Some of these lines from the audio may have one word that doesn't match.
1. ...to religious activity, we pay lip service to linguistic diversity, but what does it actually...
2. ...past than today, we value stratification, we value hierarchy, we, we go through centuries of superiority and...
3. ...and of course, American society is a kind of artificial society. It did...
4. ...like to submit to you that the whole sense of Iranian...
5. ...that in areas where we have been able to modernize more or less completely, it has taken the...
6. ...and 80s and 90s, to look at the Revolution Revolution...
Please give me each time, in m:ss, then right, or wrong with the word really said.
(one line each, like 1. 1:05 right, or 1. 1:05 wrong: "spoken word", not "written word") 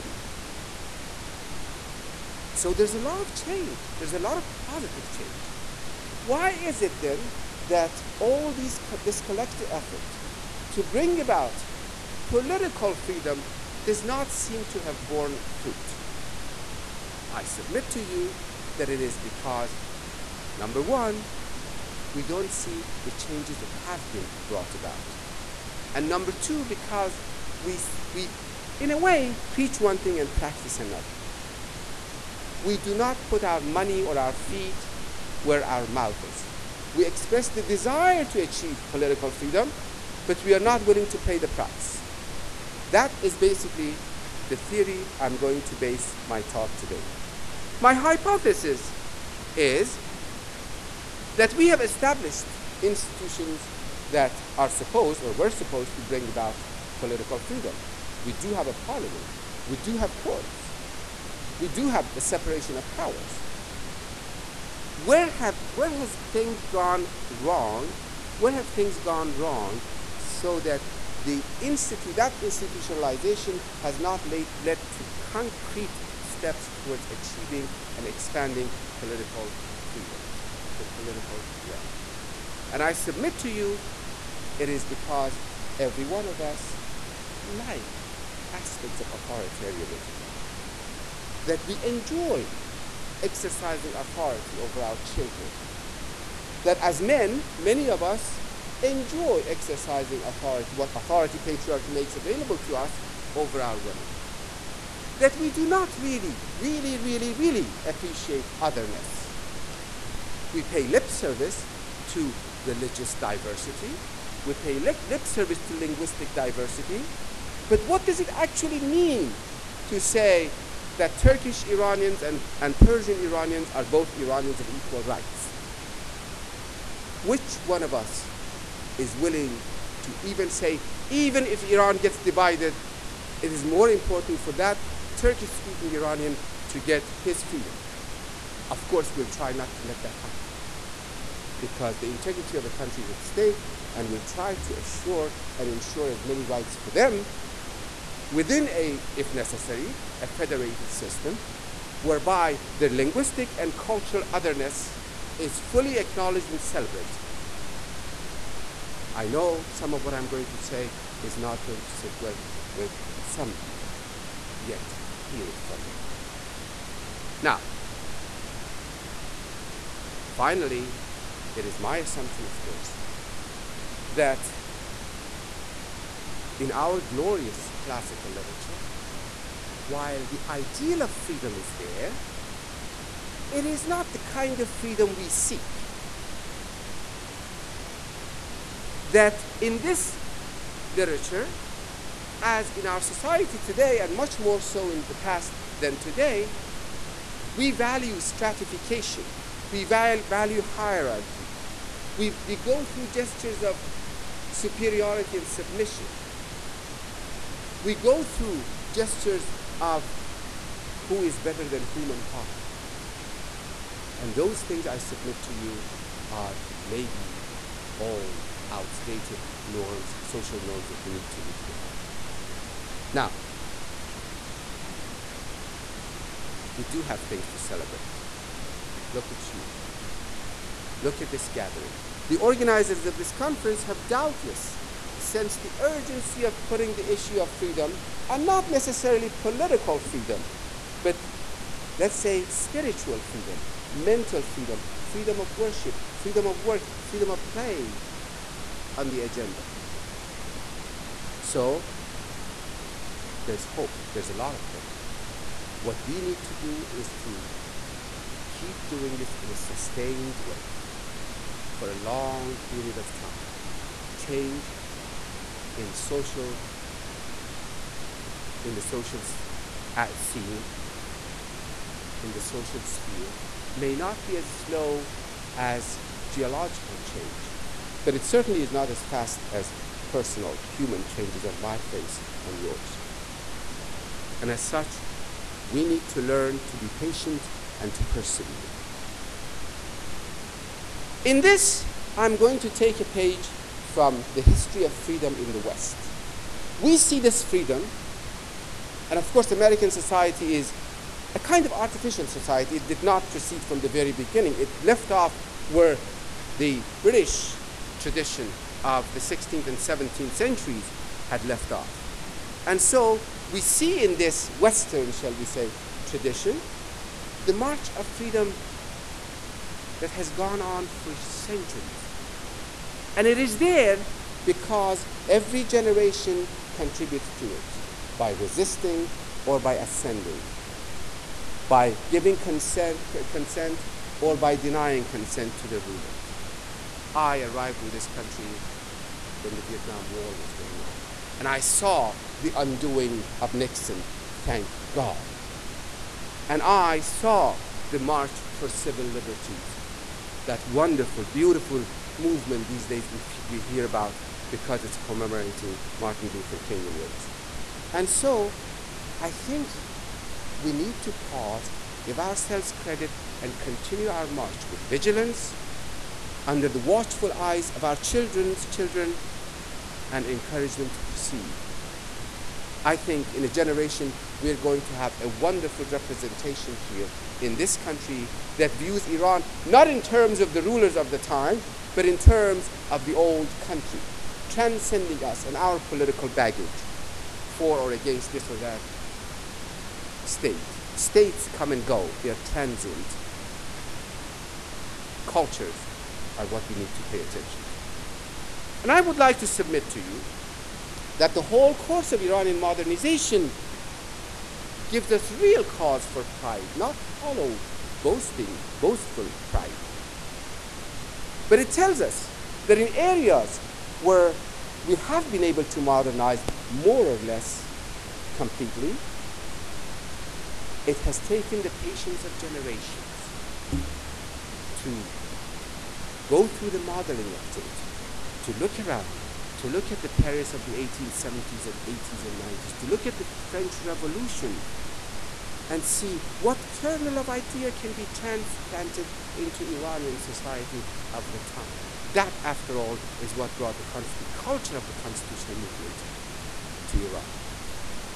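1. 1:52 wrong: "diversity", not "activity"
2. 3:15 wrong: "gestures", not "centuries"
3. 4:59 right
4. 6:39 wrong: "course", not "sense"
5. 6:52 right
6. 7:11 wrong: "French", not "Revolution".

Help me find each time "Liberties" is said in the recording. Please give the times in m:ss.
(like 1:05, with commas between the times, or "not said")
5:49.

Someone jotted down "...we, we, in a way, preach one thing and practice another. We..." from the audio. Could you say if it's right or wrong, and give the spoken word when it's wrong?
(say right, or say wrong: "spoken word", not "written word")
right.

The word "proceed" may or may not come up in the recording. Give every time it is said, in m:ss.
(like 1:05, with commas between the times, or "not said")
5:03, 6:11.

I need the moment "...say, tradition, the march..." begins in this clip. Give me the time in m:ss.
5:15.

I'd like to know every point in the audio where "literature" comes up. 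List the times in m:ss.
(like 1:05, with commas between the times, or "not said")
2:58, 3:10.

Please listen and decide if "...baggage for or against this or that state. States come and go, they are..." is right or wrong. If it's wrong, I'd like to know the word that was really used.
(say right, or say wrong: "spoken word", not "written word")
right.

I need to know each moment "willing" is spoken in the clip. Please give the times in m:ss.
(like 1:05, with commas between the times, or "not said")
0:40, 2:09.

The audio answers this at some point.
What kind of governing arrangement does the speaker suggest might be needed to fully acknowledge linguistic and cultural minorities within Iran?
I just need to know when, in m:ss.
2:30.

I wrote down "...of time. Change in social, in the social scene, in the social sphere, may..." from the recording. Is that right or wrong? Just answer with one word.
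right.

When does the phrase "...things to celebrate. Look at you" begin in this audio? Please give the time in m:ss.
3:47.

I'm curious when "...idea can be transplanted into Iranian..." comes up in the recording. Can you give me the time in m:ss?
7:17.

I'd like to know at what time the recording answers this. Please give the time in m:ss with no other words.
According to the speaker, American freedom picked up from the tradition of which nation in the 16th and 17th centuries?
5:07.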